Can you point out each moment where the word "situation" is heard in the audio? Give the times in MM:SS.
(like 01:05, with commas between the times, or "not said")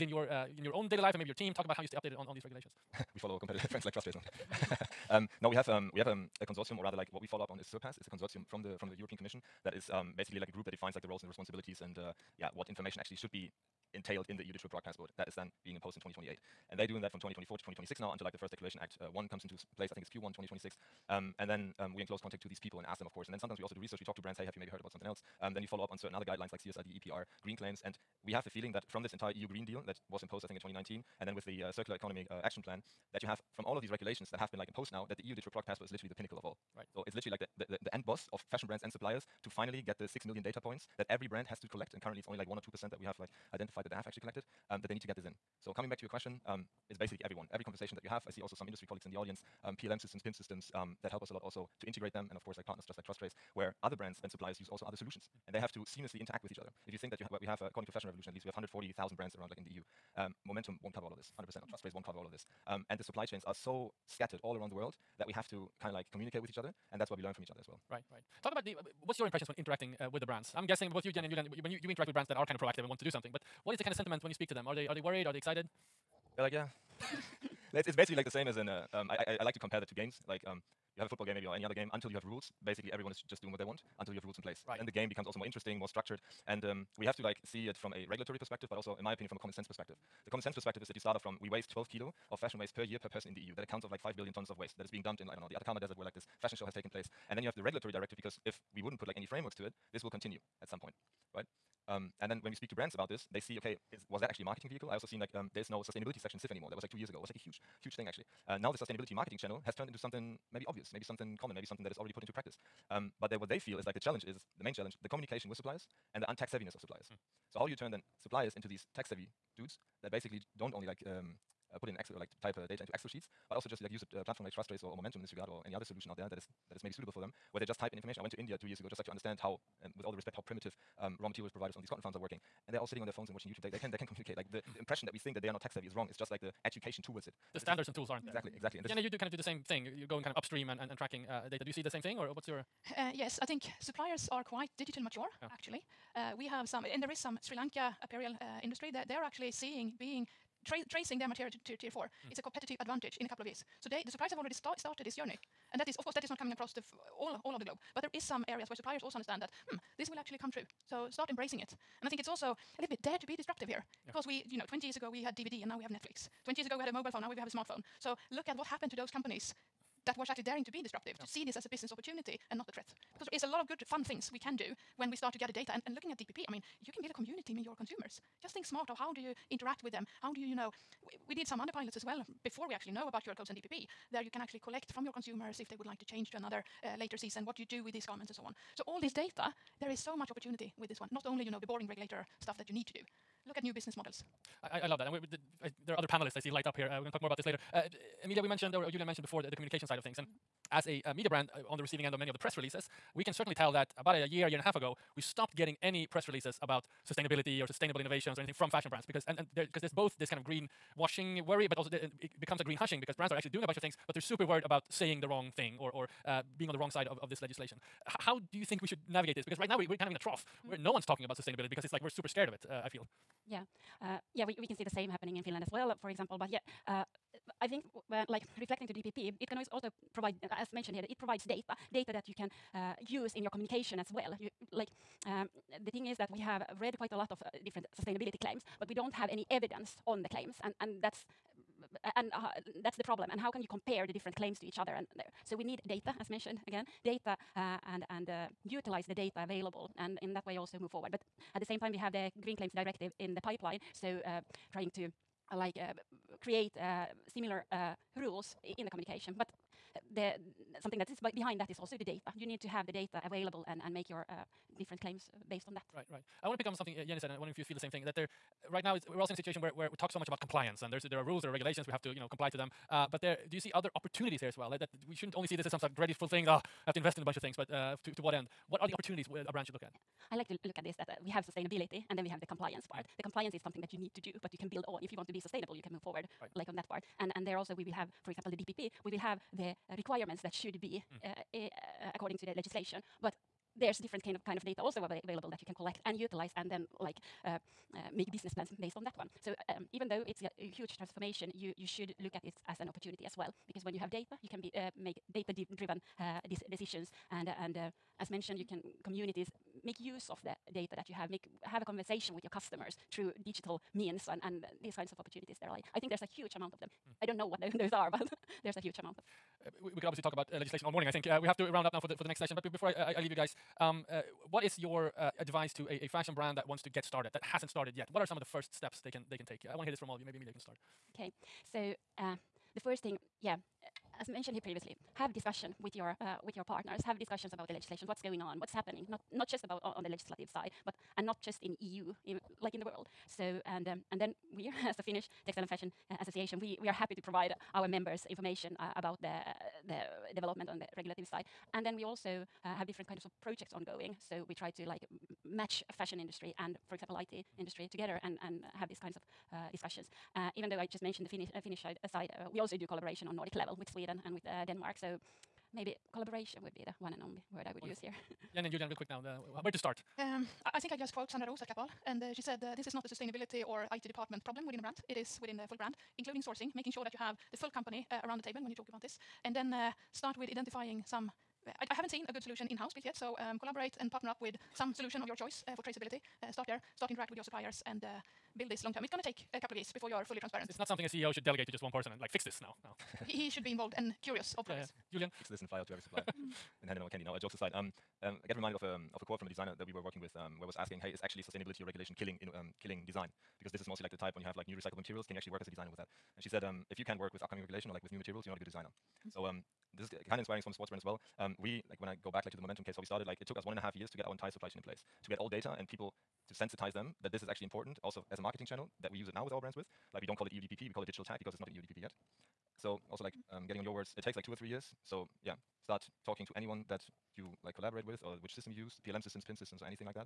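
04:29.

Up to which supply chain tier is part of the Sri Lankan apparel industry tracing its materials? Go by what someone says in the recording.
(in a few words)
tier four.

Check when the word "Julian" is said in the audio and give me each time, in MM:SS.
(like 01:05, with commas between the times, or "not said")
01:11, 03:18, 06:08, 06:35.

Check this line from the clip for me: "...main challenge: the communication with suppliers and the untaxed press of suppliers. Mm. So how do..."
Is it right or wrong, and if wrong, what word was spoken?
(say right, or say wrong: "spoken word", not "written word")
wrong: "heaviness", not "press".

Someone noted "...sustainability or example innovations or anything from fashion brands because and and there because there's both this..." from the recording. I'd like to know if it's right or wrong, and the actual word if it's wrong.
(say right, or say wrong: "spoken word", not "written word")
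wrong: "sustainable", not "example".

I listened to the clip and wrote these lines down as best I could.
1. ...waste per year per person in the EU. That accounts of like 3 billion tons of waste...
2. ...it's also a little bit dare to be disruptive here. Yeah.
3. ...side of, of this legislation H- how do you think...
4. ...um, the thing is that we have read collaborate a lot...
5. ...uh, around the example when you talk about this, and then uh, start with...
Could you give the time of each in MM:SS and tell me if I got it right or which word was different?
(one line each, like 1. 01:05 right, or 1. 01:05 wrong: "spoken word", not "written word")
1. 01:32 wrong: "5", not "3"
2. 02:42 right
3. 03:36 right
4. 03:55 wrong: "quite", not "collaborate"
5. 06:18 wrong: "table", not "example".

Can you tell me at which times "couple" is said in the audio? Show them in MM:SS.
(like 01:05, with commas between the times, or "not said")
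02:33, 06:29.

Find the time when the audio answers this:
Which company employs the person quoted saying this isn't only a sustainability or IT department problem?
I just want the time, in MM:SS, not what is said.
06:11.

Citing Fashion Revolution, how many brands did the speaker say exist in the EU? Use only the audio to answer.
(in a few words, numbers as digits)
140,000.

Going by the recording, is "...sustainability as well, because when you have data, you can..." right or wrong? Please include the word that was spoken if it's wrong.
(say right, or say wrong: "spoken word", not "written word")
wrong: "opportunity", not "sustainability".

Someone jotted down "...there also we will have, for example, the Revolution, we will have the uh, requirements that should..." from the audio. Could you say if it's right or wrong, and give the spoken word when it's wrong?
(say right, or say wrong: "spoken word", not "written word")
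wrong: "DPP", not "Revolution".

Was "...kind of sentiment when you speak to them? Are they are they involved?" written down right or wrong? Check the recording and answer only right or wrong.
wrong.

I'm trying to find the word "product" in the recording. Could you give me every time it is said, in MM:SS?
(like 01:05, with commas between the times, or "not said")
00:14, 00:35.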